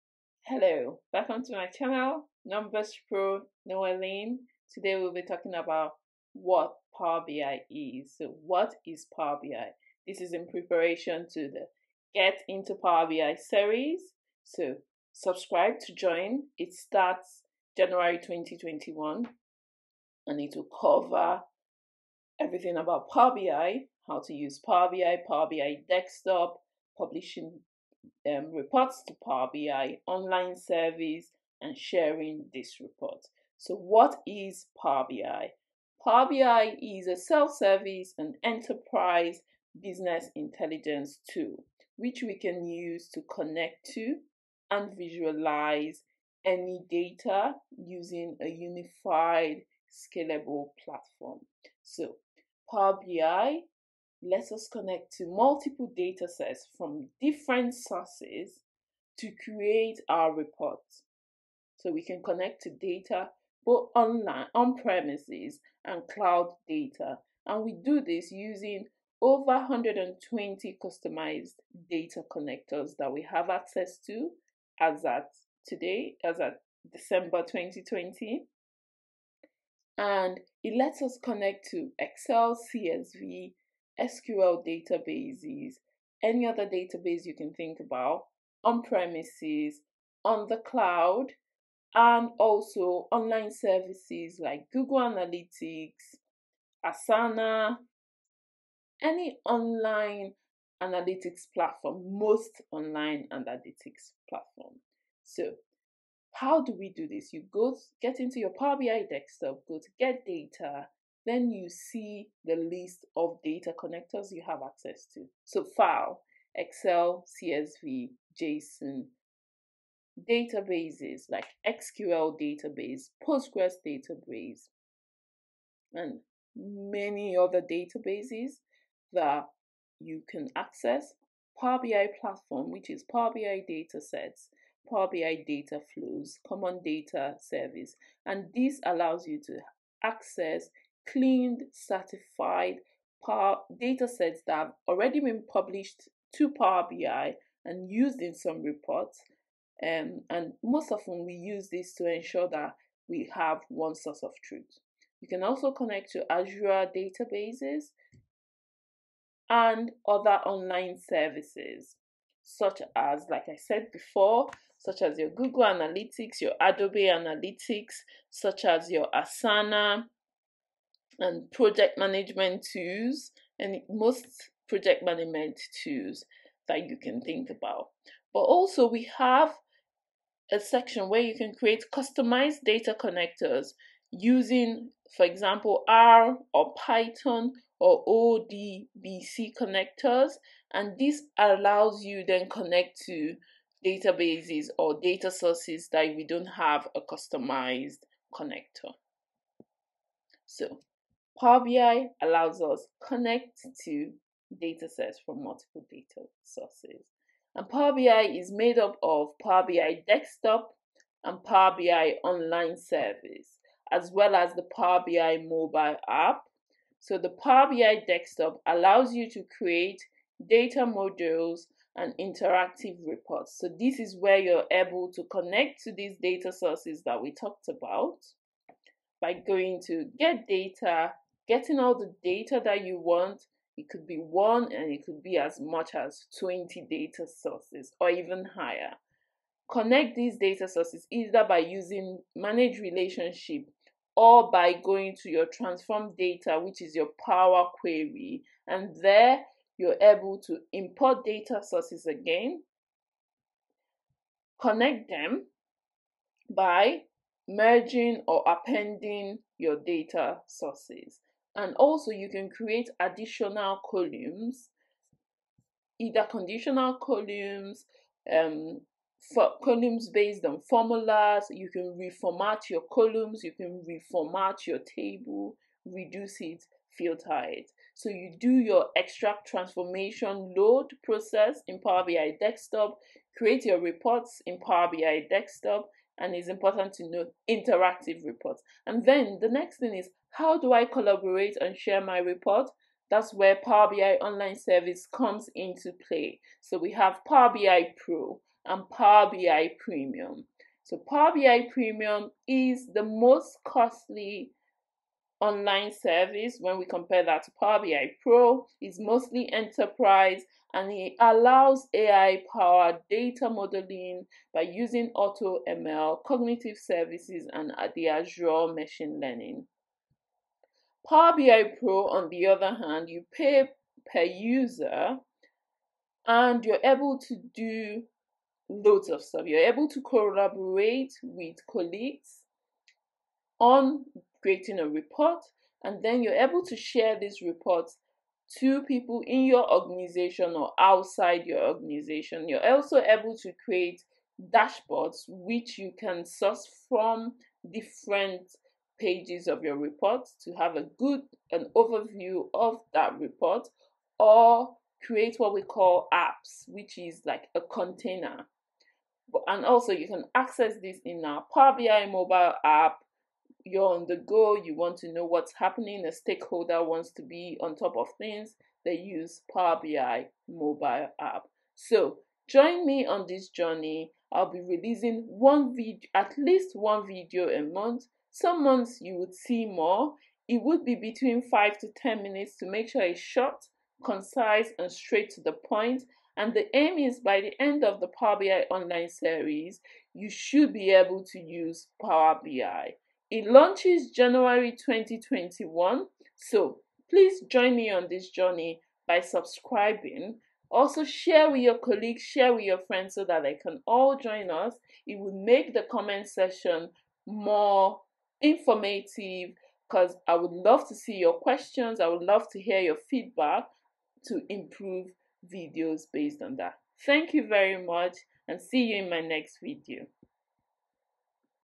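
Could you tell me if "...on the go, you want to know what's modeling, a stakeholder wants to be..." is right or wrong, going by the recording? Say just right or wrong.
wrong.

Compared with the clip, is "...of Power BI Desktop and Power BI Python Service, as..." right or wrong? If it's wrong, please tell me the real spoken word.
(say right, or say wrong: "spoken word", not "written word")
wrong: "Online", not "Python".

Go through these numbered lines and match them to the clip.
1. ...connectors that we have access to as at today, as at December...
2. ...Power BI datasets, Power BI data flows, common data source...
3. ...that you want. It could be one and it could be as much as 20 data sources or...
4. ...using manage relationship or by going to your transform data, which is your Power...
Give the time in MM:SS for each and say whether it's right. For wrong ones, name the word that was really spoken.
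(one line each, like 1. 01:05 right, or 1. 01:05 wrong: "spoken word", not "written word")
1. 01:12 right
2. 02:13 wrong: "service", not "source"
3. 03:52 right
4. 04:01 right.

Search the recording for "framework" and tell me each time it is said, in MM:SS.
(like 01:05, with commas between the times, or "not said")
not said.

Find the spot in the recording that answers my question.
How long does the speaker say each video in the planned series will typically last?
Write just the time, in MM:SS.
06:21.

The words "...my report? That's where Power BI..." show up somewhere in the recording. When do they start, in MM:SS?
04:52.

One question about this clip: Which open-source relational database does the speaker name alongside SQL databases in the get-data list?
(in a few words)
Postgres.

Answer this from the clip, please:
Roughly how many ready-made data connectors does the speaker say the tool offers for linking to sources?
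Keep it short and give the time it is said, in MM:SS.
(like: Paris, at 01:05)
over 120, at 01:09.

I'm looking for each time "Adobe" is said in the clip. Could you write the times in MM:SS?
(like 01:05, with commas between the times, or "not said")
02:46.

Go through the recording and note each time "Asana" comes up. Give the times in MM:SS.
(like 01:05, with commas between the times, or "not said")
01:36, 02:49.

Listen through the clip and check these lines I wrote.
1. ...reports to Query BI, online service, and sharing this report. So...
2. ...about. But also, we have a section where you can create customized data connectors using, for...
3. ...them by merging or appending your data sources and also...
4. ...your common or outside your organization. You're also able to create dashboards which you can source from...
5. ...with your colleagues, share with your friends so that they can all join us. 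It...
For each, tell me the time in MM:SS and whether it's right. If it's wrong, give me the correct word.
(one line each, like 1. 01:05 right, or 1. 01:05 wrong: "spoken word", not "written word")
1. 00:28 wrong: "Power", not "Query"
2. 02:57 right
3. 04:15 right
4. 05:39 wrong: "organization", not "common"
5. 06:41 right.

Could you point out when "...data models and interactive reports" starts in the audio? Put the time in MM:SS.
03:40.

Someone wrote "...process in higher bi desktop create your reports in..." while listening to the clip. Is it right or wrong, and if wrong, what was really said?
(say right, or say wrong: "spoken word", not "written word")
wrong: "power", not "higher".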